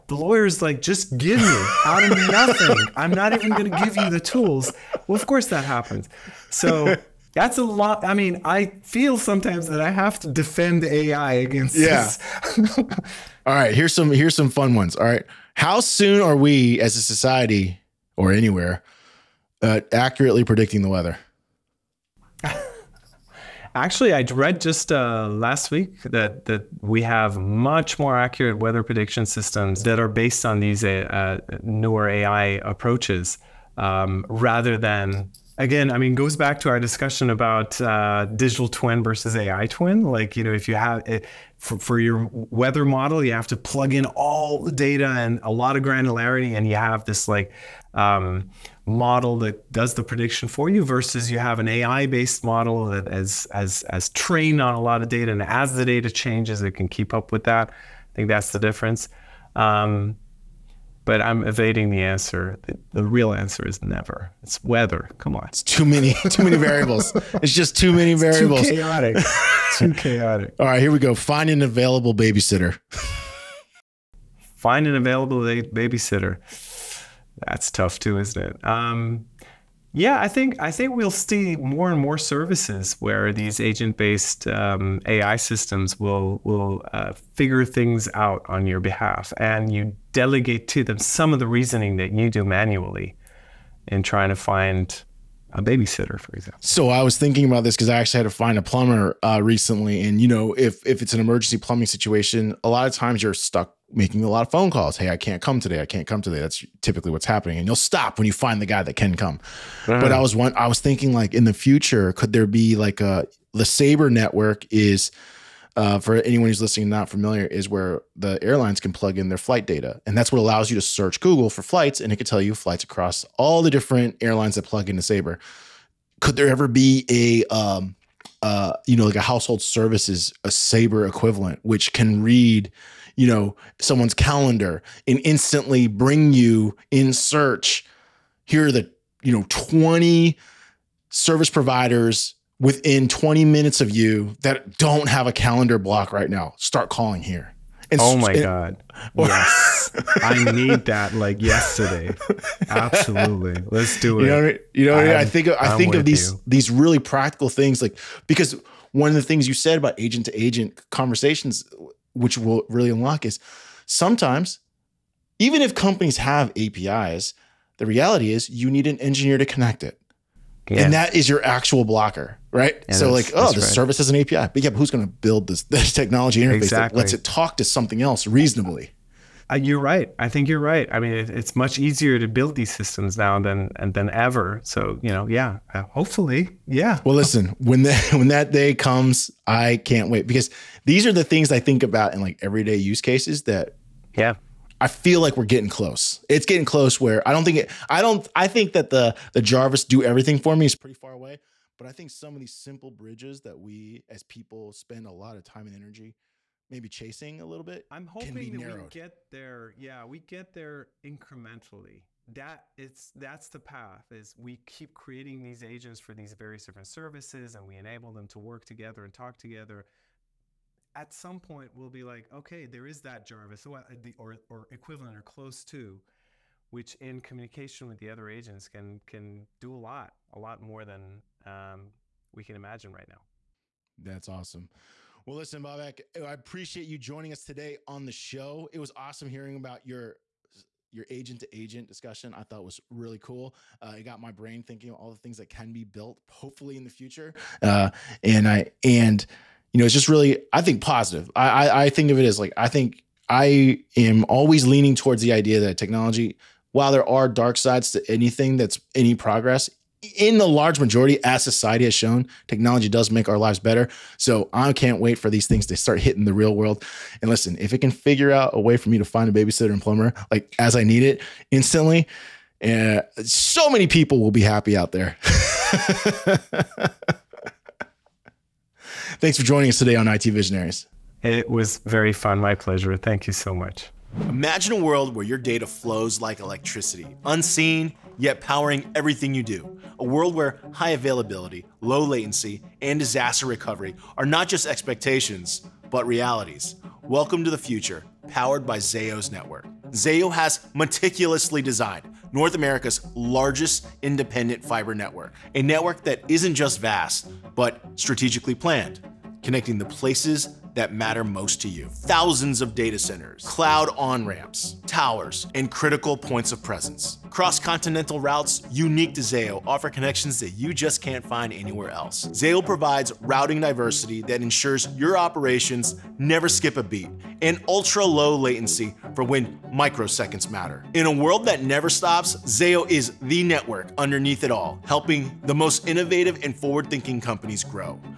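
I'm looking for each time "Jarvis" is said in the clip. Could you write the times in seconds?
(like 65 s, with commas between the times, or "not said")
199 s, 223 s.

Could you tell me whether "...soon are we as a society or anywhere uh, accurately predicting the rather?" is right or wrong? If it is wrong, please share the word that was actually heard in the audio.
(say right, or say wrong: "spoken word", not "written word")
wrong: "weather", not "rather".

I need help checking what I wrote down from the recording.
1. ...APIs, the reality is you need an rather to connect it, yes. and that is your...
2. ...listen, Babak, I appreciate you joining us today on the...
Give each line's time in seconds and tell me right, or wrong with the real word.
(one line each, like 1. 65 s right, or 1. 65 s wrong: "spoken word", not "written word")
1. 166 s wrong: "engineer", not "rather"
2. 235 s right.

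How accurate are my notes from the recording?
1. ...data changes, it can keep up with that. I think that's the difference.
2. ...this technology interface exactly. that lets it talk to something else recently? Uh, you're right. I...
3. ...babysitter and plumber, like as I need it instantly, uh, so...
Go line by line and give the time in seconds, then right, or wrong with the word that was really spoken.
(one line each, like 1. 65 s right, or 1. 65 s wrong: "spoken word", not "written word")
1. 55 s right
2. 175 s wrong: "reasonably", not "recently"
3. 269 s right.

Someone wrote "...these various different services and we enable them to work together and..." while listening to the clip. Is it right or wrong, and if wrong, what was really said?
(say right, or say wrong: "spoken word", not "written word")
right.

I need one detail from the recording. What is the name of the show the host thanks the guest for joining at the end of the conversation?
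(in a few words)
IT Visionaries.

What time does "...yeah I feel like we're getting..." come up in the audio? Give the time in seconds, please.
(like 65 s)
194 s.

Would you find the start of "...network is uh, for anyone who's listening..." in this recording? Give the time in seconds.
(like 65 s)
114 s.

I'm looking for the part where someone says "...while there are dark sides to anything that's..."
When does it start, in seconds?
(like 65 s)
256 s.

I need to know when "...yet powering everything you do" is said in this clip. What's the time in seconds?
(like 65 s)
288 s.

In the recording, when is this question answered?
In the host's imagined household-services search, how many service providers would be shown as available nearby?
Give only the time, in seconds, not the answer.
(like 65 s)
139 s.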